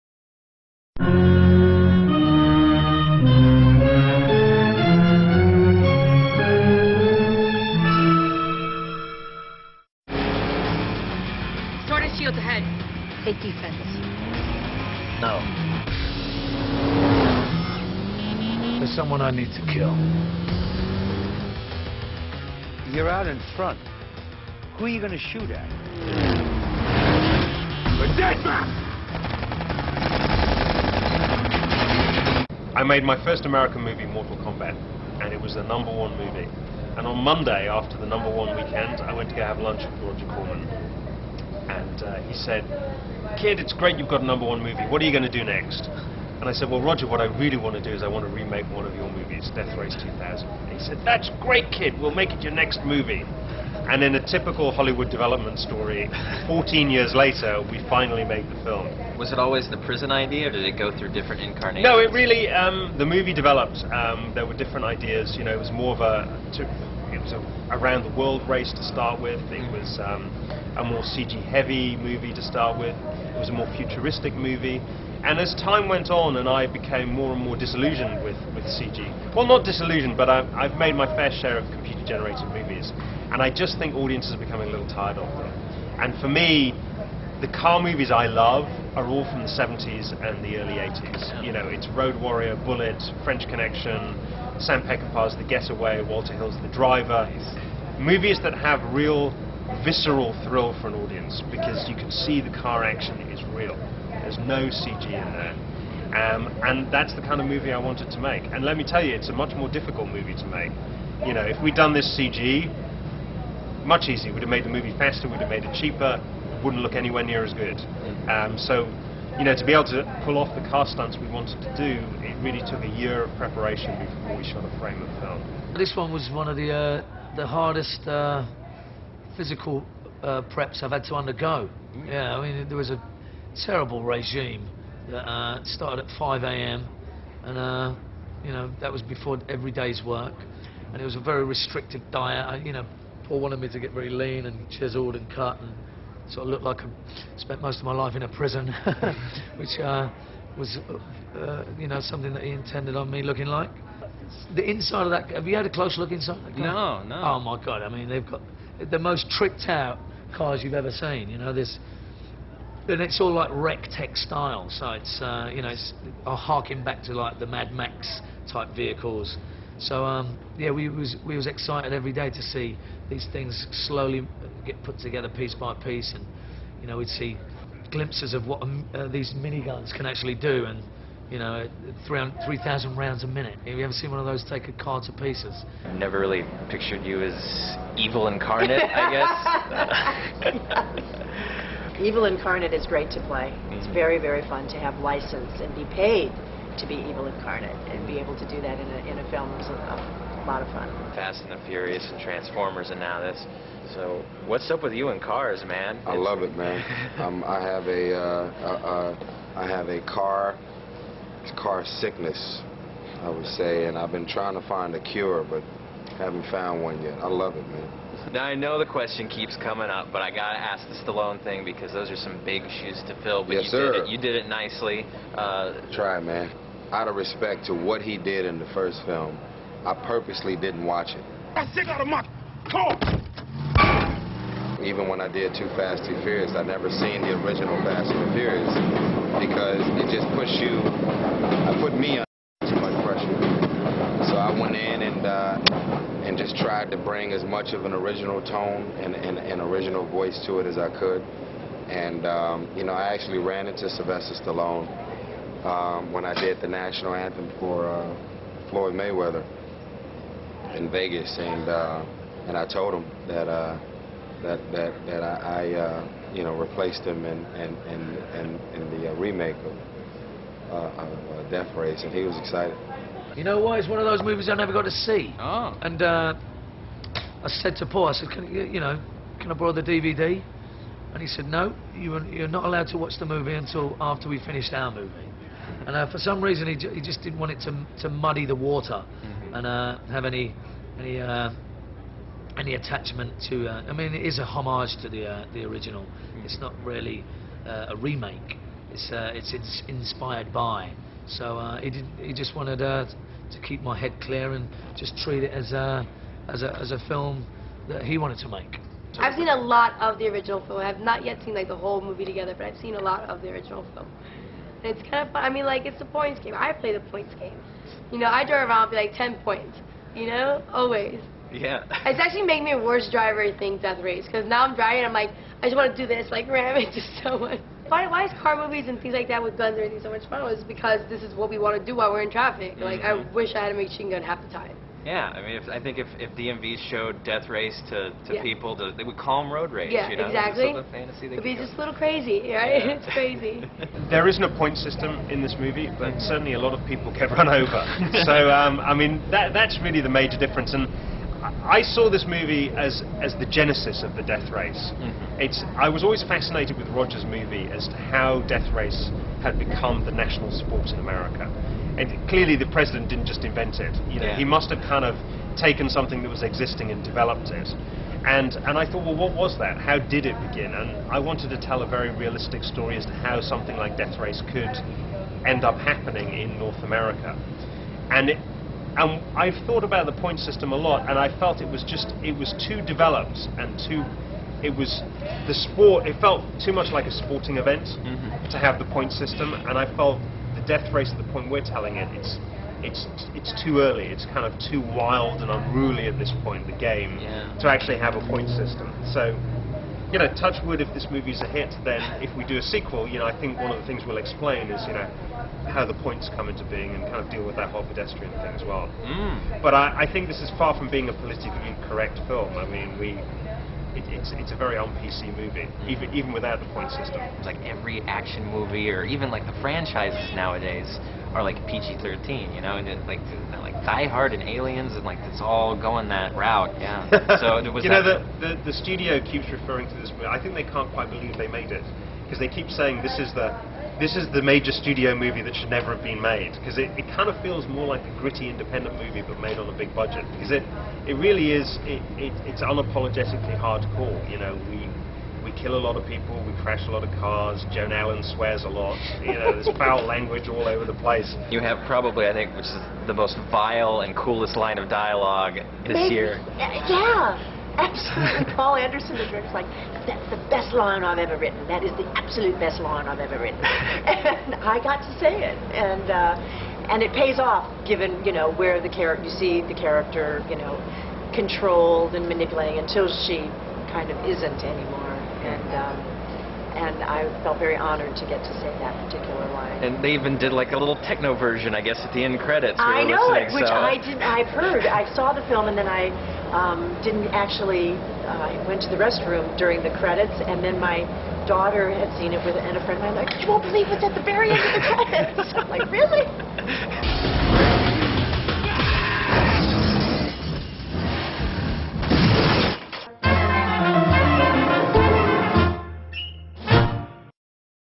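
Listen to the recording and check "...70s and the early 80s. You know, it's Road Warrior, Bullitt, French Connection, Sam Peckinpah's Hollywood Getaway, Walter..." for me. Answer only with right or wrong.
wrong.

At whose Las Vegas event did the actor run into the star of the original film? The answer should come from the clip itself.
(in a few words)
Floyd Mayweather.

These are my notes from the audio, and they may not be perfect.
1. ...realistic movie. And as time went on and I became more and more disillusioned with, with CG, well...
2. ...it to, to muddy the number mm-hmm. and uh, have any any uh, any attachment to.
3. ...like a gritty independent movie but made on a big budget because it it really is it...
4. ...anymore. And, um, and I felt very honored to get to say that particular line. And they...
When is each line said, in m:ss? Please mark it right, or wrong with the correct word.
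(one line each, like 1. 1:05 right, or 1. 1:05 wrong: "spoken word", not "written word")
1. 1:13 wrong: "futuristic", not "realistic"
2. 4:47 wrong: "water", not "number"
3. 7:17 right
4. 7:54 right.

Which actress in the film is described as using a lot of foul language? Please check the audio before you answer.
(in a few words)
Joan Allen.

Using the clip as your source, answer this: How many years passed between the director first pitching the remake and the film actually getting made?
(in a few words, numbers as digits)
14.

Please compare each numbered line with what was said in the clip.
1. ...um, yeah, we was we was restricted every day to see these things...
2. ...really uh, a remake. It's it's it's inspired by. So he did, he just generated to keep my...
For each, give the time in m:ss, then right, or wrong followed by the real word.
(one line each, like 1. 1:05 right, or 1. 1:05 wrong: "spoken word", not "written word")
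1. 2:50 wrong: "excited", not "restricted"
2. 4:56 wrong: "wanted", not "generated".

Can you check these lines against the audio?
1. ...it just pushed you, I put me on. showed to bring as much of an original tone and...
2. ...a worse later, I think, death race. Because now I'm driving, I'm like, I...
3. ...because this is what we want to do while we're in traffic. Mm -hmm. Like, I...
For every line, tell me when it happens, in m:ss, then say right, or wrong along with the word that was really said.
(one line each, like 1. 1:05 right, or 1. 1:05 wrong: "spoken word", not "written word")
1. 4:00 wrong: "tried", not "showed"
2. 5:22 wrong: "driver", not "later"
3. 5:30 right.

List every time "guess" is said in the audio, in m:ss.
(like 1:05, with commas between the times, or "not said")
3:10, 8:01.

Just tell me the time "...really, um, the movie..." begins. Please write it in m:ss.
1:02.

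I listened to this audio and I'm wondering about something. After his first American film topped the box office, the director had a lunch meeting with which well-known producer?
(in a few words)
Roger Corman.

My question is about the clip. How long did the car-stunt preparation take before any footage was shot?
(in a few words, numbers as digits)
a year.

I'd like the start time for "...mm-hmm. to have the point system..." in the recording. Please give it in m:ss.
6:27.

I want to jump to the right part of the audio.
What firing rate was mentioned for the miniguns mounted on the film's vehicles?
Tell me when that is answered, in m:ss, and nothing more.
3:02.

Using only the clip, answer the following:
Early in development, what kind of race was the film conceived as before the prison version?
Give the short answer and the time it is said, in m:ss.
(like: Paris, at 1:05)
around the world race, at 1:07.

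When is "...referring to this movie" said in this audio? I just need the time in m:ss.
7:09.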